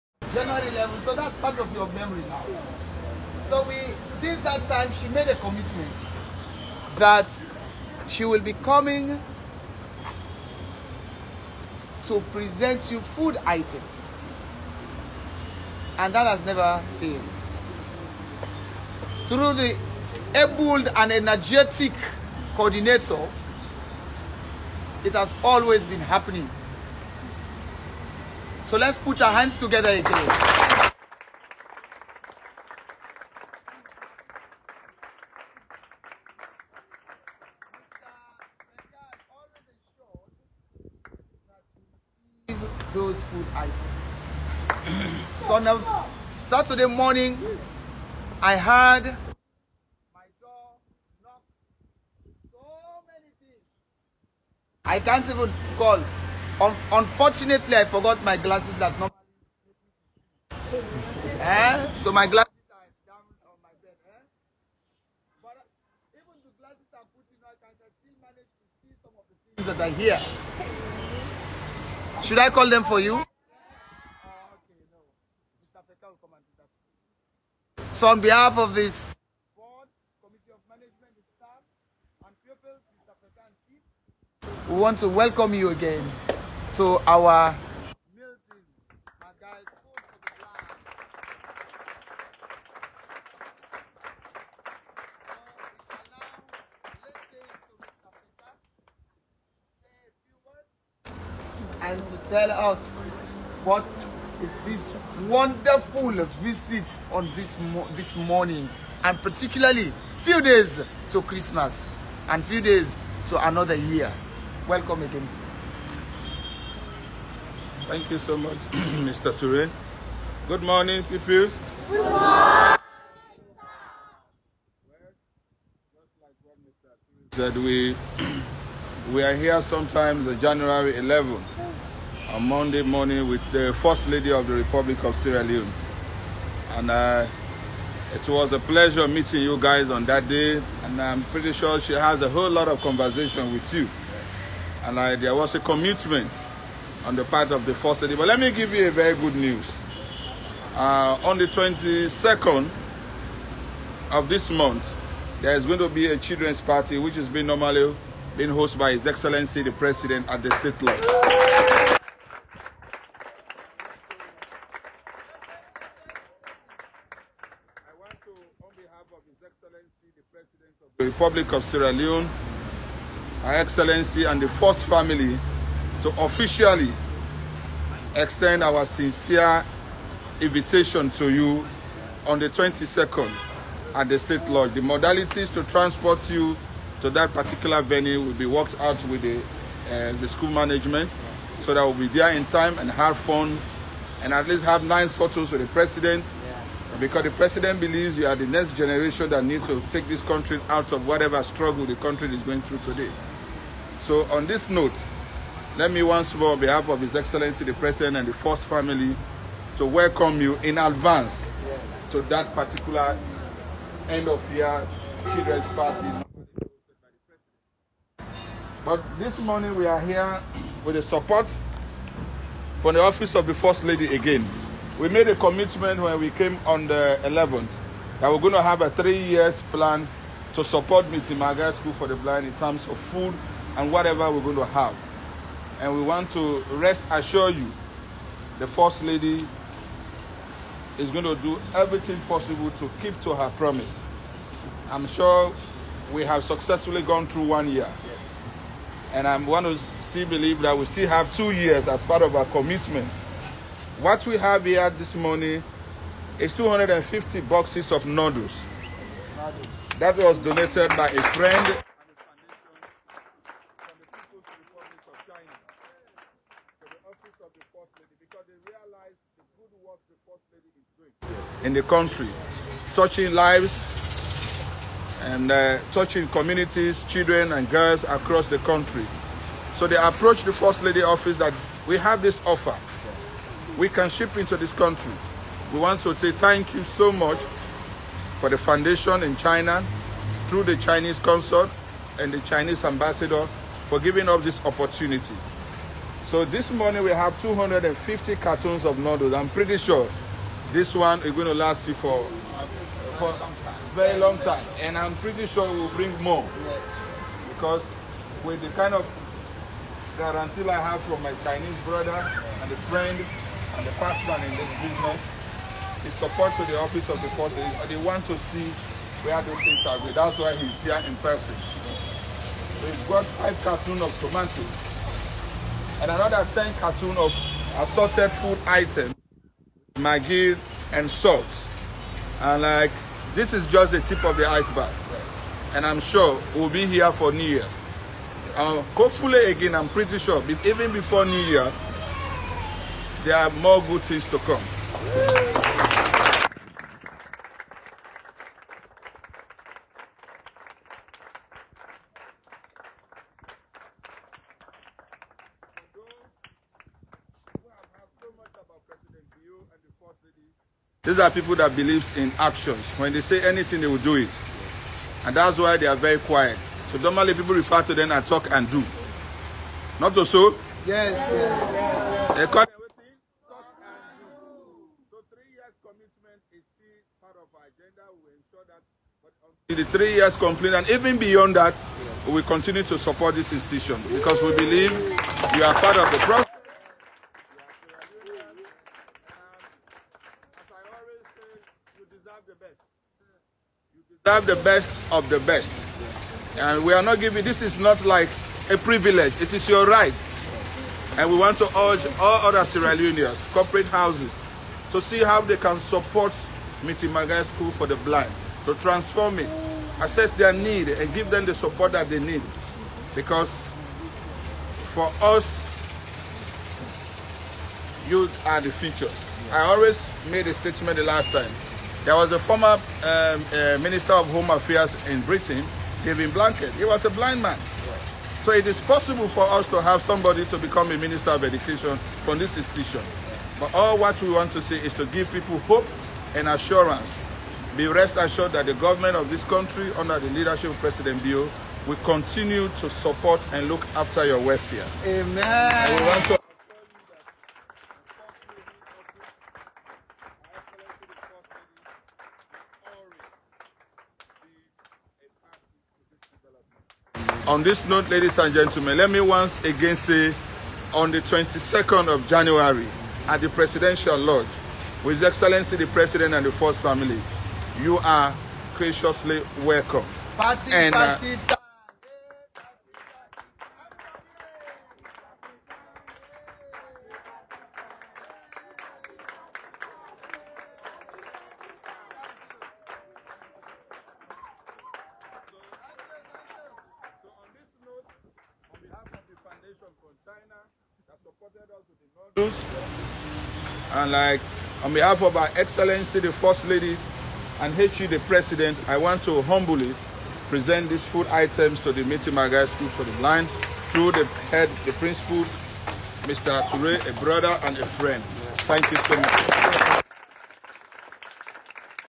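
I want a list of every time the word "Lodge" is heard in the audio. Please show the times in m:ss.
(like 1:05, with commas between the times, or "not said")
2:40, 3:04, 7:44.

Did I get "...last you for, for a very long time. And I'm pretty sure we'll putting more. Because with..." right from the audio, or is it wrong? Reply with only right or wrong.
wrong.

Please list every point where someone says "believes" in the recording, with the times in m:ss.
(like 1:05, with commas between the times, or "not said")
3:17, 4:10, 6:01, 6:24.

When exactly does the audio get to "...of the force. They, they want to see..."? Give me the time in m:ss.
5:17.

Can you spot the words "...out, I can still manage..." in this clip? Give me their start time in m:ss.
1:07.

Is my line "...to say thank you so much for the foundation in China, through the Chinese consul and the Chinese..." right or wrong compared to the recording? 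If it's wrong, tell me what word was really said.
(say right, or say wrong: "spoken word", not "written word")
right.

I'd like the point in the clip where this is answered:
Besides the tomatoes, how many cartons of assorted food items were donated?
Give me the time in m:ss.
5:26.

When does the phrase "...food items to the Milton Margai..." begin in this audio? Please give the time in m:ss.
8:21.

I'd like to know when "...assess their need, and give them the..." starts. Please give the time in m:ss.
6:50.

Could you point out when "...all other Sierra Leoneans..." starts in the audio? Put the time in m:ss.
6:42.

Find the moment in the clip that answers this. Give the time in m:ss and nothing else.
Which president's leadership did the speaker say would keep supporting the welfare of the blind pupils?
7:20.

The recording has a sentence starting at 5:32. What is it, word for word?
And like, this is just the tip of the iceberg.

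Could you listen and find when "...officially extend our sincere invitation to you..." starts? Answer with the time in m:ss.
2:56.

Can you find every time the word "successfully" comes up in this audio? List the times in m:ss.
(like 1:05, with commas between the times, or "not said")
4:06.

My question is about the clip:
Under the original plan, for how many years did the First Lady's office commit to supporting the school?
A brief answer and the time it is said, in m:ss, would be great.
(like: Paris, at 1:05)
3, at 3:48.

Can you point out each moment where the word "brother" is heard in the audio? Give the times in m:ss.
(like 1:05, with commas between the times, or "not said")
5:11, 8:27.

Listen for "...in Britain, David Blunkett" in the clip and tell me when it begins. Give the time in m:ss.
7:05.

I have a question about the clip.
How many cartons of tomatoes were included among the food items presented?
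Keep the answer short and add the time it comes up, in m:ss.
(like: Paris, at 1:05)
5, at 5:23.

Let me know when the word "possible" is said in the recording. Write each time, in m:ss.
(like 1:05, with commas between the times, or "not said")
4:02, 7:08.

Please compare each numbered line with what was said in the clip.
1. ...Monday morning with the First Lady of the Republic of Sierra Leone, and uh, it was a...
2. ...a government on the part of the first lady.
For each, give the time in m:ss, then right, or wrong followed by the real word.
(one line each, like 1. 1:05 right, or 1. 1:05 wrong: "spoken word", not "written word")
1. 2:12 right
2. 2:25 wrong: "commitment", not "government".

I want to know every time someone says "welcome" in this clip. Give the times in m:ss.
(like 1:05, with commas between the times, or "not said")
1:25, 1:54, 3:29, 7:49.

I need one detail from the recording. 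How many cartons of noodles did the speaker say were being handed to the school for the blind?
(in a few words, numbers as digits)
250.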